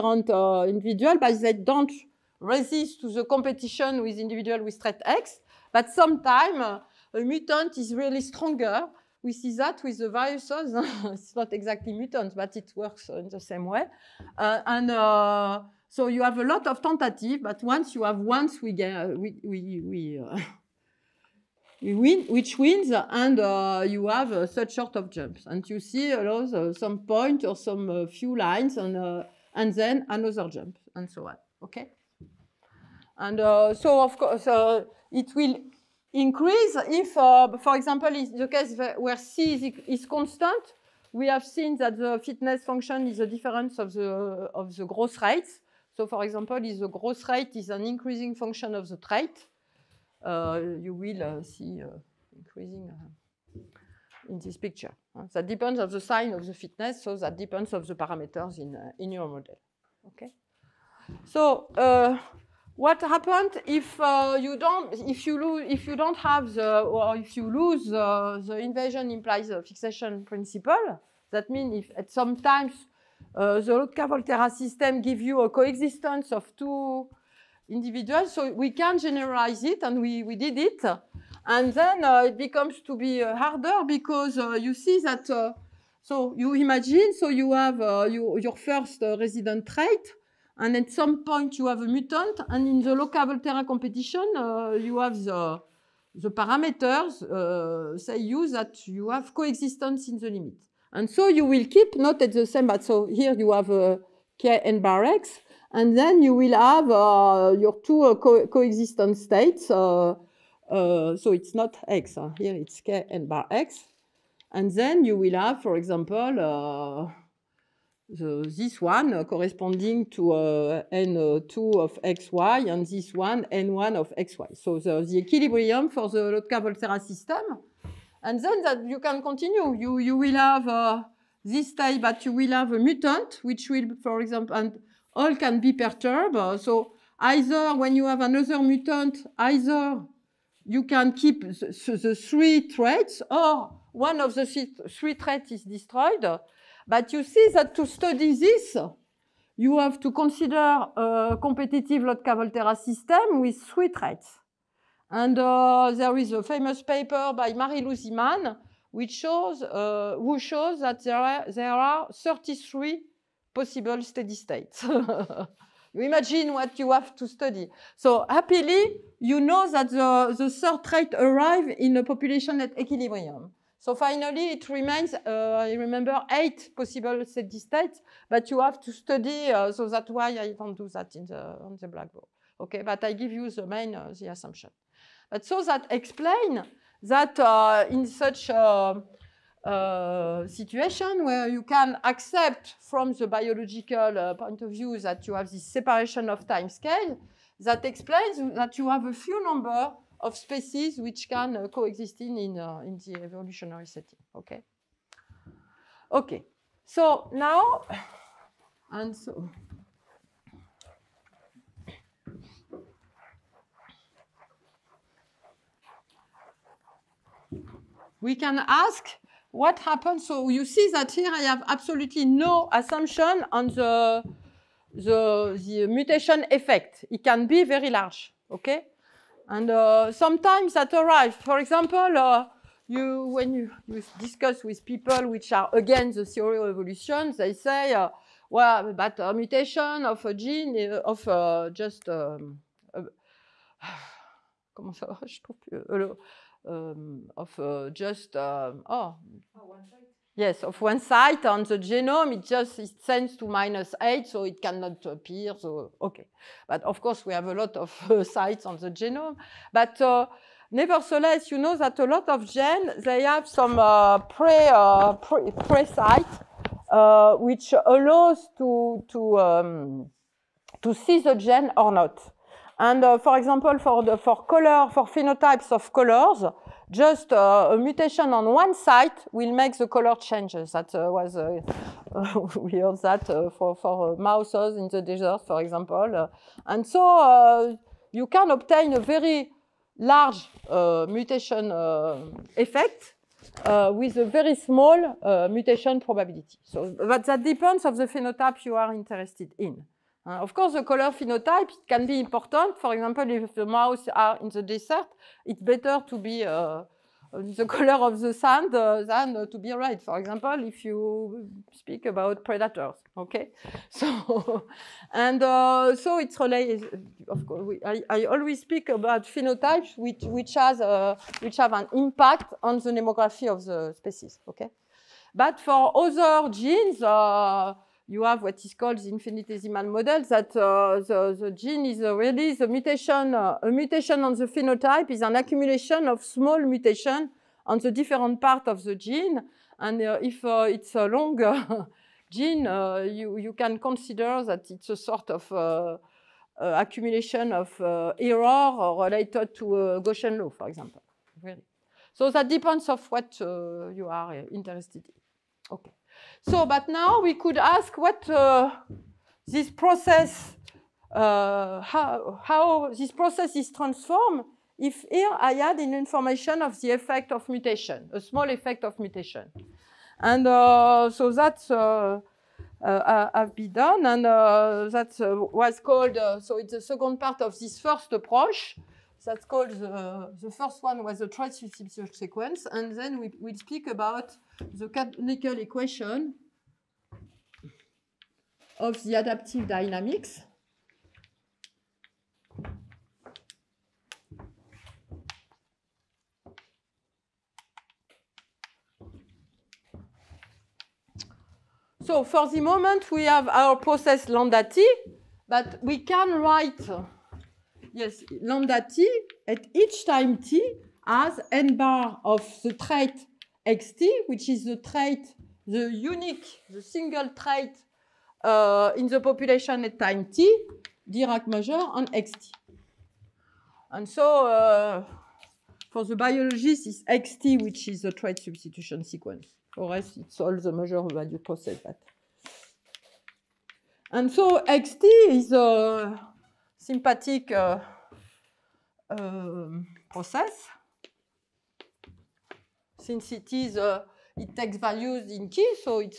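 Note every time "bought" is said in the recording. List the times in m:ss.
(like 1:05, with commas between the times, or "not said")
not said.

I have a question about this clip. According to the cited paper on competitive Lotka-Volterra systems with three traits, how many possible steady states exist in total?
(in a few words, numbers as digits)
33.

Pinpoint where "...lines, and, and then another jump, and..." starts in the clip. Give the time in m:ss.
0:28.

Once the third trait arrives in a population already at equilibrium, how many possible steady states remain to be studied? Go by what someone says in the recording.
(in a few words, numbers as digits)
8.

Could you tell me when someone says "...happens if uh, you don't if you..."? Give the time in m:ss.
1:03.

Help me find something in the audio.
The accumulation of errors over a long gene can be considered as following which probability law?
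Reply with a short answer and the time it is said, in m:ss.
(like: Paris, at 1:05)
Gaussian law, at 5:50.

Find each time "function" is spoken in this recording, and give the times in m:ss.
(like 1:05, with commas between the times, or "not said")
0:42, 0:48.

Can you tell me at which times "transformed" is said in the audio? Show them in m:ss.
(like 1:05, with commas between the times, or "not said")
6:03.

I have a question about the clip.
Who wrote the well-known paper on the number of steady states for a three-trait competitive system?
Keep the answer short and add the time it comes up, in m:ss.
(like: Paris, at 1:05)
Marie-Lou Man, at 2:37.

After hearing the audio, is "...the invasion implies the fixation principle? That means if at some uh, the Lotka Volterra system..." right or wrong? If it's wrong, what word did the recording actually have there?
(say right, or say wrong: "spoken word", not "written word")
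right.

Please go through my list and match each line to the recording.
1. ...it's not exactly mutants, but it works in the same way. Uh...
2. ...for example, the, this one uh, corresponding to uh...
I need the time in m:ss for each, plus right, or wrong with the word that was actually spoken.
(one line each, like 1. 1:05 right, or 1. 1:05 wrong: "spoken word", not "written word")
1. 0:11 right
2. 1:55 right.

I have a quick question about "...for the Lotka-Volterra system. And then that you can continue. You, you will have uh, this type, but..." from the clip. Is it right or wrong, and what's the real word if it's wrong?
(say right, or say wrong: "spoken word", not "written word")
right.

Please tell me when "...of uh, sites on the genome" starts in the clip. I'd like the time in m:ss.
4:17.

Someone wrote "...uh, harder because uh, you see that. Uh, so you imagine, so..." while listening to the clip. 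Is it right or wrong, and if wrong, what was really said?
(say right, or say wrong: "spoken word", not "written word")
right.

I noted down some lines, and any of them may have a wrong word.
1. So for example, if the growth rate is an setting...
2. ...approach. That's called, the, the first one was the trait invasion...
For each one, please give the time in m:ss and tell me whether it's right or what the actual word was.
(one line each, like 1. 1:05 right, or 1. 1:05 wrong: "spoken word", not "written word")
1. 0:45 wrong: "increasing", not "setting"
2. 6:18 wrong: "substitution", not "invasion".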